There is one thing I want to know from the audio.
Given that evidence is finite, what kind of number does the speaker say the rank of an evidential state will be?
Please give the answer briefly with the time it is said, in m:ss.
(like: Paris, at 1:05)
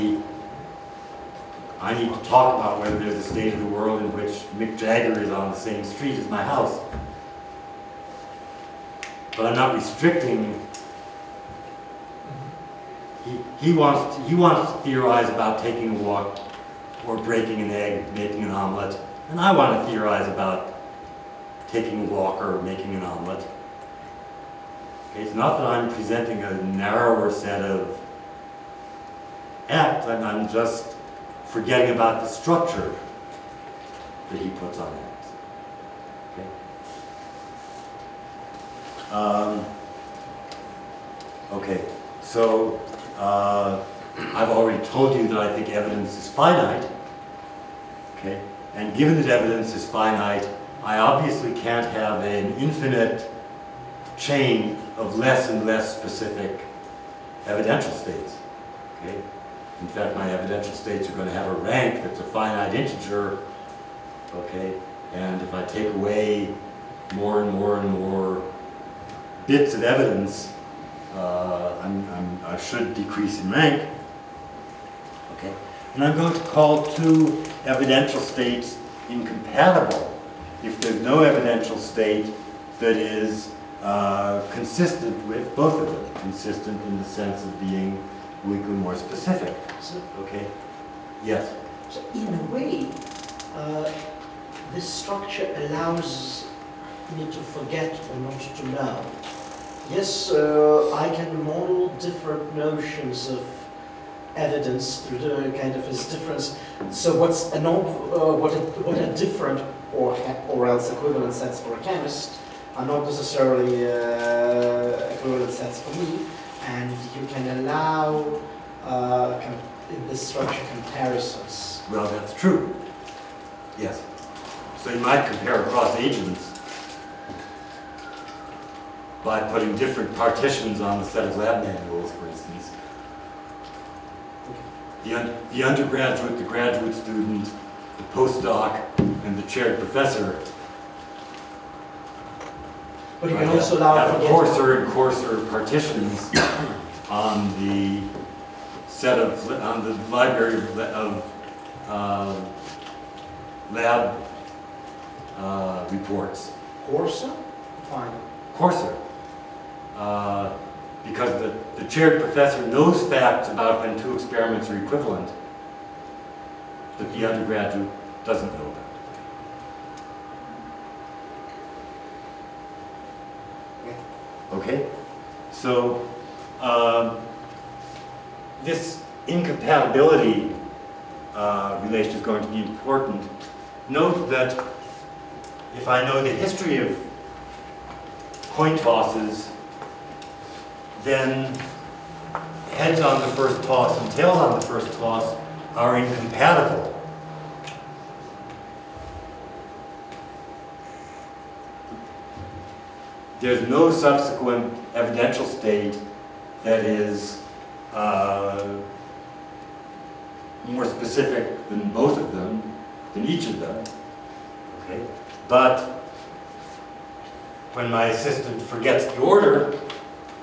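finite integer, at 1:02.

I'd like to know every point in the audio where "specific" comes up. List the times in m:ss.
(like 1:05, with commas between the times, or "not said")
0:55, 1:28, 3:30.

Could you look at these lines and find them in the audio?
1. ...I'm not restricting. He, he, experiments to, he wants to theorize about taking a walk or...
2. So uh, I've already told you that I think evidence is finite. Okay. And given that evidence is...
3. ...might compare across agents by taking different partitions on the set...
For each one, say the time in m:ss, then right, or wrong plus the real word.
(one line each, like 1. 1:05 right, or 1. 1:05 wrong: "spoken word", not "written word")
1. 0:09 wrong: "wants", not "experiments"
2. 0:42 right
3. 2:04 wrong: "putting", not "taking".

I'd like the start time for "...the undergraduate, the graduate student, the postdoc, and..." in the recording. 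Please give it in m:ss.
2:15.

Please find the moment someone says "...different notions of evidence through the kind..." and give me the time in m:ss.
1:41.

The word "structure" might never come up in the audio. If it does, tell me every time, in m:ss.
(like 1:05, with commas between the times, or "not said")
0:32, 1:34, 2:00.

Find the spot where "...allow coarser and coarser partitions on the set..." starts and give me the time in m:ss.
2:23.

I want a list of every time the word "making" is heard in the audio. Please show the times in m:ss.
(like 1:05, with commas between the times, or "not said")
0:18, 0:22.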